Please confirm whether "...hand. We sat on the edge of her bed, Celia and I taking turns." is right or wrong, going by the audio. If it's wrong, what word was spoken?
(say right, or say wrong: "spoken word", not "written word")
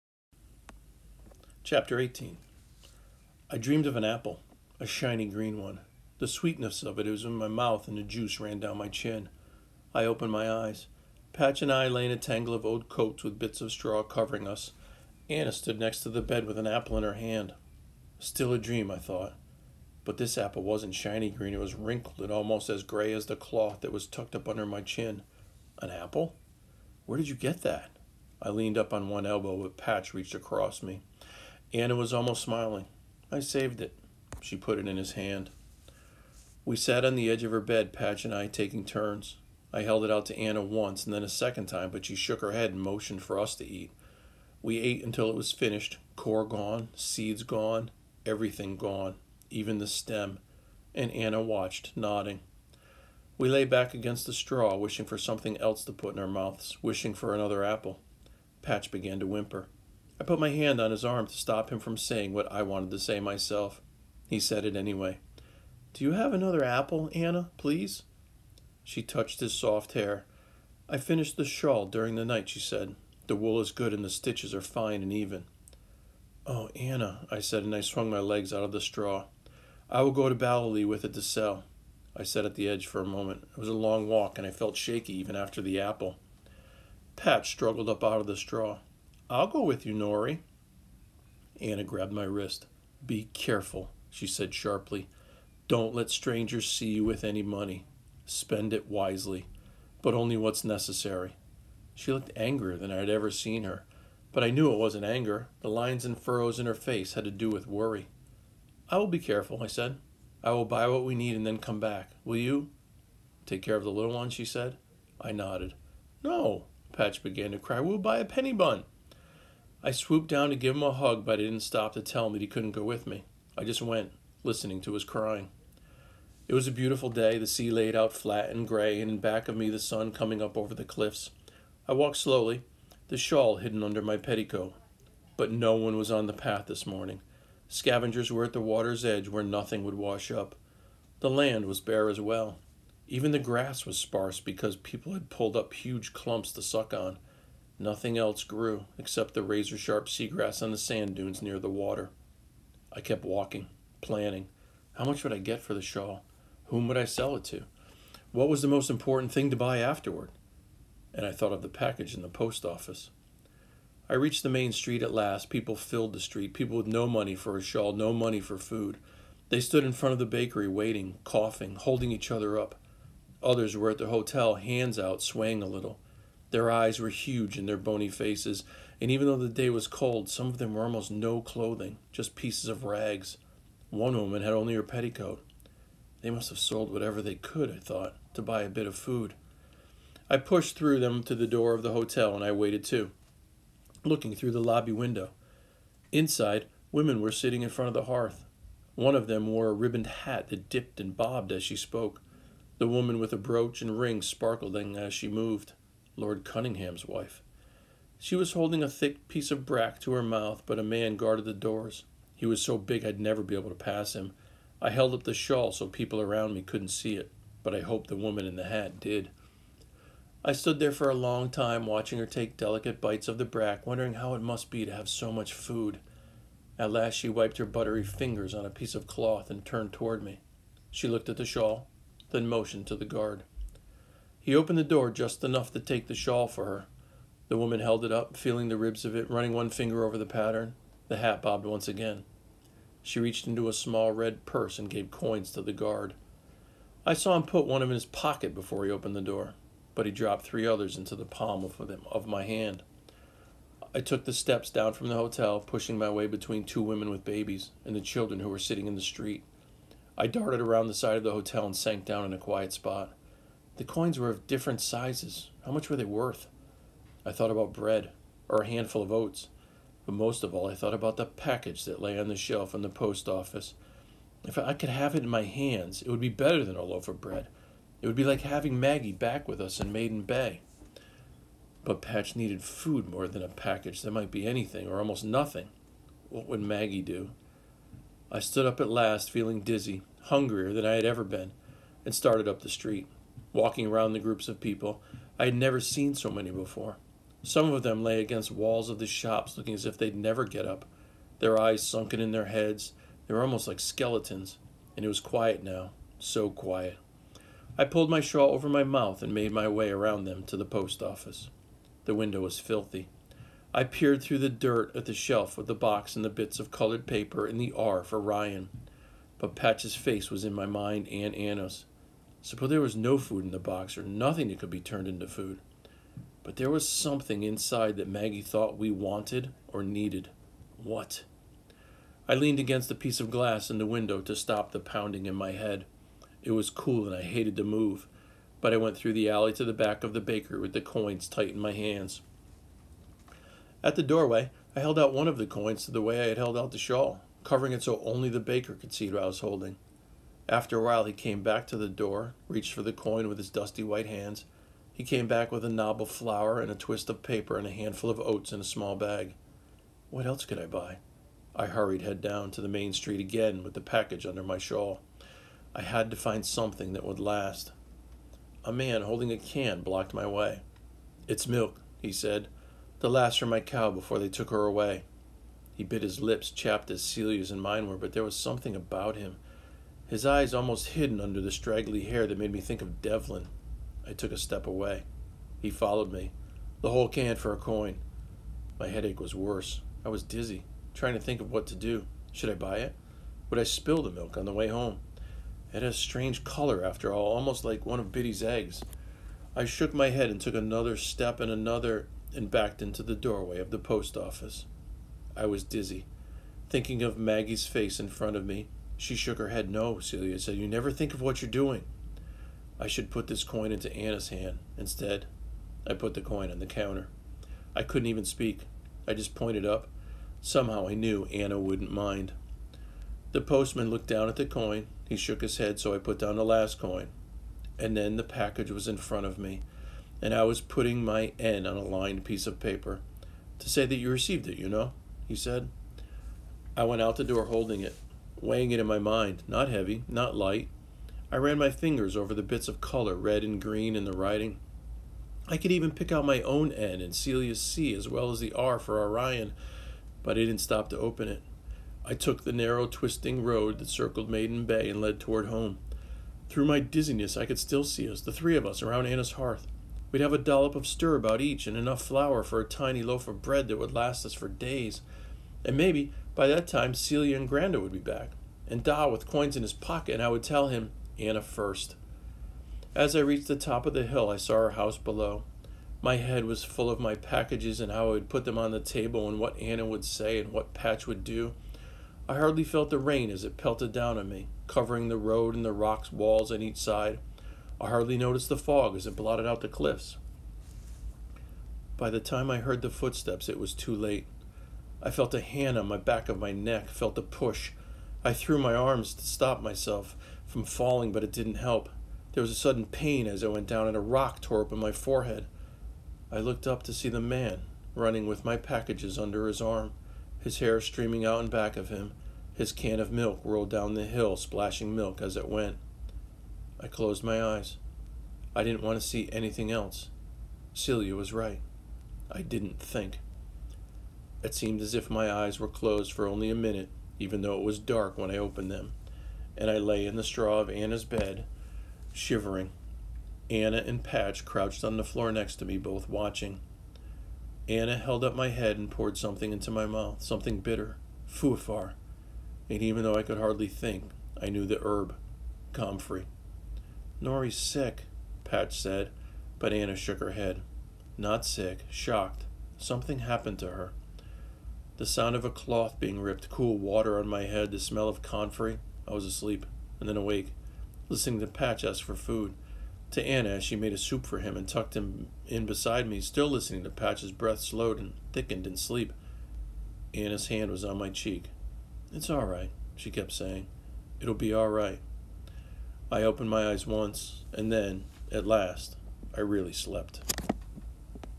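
wrong: "Patch", not "Celia".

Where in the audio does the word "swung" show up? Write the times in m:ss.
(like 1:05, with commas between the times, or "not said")
1:17.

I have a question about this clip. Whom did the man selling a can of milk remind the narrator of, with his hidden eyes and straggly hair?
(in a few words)
Devlin.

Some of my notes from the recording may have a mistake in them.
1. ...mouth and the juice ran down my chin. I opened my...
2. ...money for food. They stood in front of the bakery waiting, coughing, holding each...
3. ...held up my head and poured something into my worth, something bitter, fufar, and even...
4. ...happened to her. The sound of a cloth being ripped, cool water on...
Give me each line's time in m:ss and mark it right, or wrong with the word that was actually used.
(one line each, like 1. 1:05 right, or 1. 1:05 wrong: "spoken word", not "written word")
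1. 0:07 right
2. 2:48 right
3. 8:57 wrong: "mouth", not "worth"
4. 9:13 right.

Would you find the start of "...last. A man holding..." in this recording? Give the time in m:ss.
6:07.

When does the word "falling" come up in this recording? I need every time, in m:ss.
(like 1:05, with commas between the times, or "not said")
8:20.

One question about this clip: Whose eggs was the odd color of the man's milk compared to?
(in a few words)
Biddy.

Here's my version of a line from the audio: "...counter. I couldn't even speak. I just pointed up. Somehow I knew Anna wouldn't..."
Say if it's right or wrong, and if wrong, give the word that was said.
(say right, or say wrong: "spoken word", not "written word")
right.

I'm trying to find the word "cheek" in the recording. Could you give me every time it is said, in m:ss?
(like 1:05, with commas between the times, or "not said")
9:31.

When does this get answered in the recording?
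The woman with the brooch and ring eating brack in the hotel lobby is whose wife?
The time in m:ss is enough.
3:26.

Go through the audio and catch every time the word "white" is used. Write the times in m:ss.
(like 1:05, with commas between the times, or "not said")
5:53.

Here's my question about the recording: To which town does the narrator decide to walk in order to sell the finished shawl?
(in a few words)
Ballylee.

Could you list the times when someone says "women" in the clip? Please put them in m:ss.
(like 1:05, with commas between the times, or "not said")
3:16, 4:16.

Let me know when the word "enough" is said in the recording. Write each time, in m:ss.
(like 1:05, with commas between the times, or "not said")
3:55, 7:41.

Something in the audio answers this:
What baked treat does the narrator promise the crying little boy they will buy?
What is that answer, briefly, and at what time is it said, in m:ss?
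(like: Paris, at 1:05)
A penny bun, at 1:58.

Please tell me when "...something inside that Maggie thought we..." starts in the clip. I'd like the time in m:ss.
5:26.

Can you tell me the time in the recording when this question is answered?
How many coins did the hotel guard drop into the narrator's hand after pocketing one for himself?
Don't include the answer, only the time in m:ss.
4:10.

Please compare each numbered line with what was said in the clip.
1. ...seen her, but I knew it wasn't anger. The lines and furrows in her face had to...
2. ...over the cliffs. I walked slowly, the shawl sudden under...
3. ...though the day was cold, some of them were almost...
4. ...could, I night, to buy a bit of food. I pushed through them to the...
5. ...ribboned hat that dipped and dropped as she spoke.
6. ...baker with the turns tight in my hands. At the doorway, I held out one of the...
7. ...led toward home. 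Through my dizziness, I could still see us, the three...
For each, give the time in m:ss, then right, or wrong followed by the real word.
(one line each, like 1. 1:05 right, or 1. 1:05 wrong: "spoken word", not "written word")
1. 1:43 right
2. 2:10 wrong: "hidden", not "sudden"
3. 2:59 right
4. 3:07 wrong: "thought", not "night"
5. 3:19 wrong: "bobbed", not "dropped"
6. 5:40 wrong: "coins", not "turns"
7. 7:35 right.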